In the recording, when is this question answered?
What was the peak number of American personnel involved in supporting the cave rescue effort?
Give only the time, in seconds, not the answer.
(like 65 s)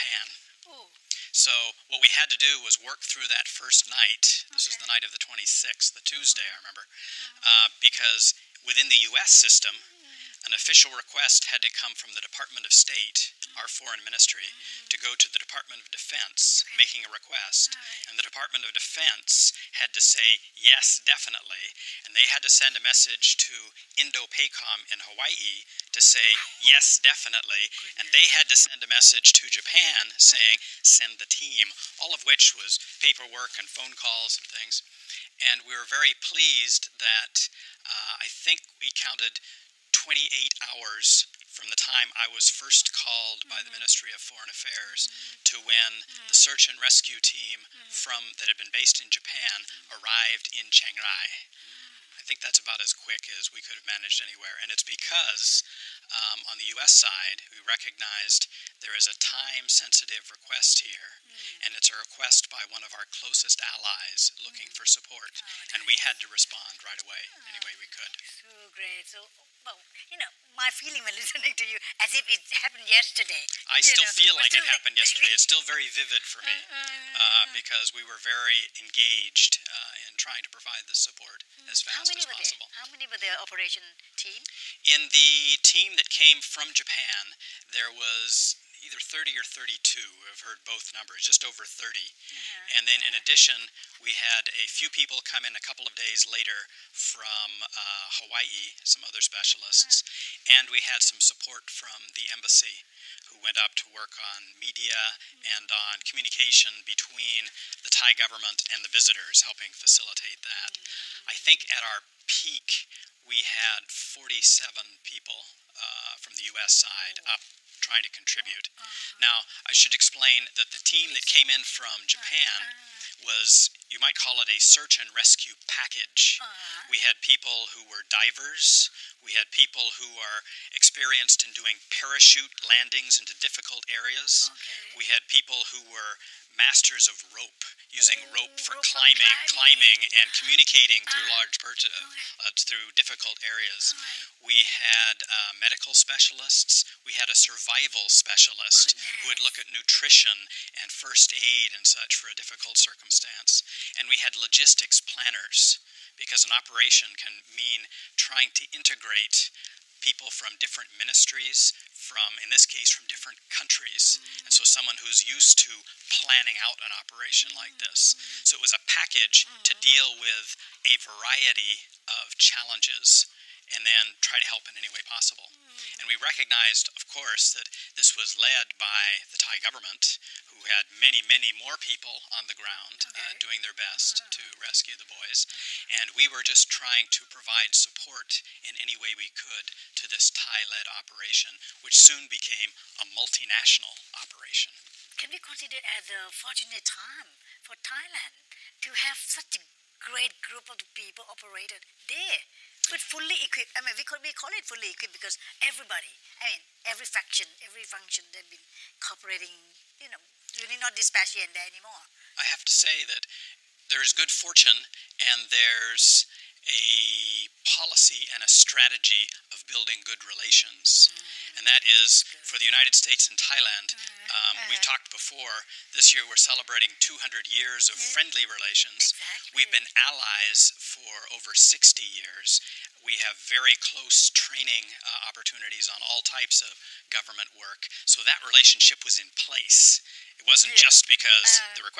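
113 s.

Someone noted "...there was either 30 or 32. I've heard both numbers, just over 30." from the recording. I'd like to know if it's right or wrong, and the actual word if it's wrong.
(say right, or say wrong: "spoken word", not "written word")
right.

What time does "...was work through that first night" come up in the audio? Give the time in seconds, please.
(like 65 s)
2 s.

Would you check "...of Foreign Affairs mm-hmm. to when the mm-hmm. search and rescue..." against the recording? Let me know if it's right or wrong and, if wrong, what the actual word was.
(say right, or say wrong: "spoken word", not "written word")
right.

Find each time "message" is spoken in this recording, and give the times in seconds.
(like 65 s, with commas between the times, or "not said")
22 s, 28 s.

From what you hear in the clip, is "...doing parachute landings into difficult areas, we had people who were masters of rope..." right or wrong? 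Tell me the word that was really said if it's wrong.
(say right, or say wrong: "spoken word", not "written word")
right.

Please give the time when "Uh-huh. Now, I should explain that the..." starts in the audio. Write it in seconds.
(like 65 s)
118 s.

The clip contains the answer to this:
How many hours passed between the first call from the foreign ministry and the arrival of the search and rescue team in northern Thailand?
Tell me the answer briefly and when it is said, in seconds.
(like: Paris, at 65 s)
28, at 40 s.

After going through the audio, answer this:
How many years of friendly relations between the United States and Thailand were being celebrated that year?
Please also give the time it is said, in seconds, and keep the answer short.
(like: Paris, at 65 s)
200, at 227 s.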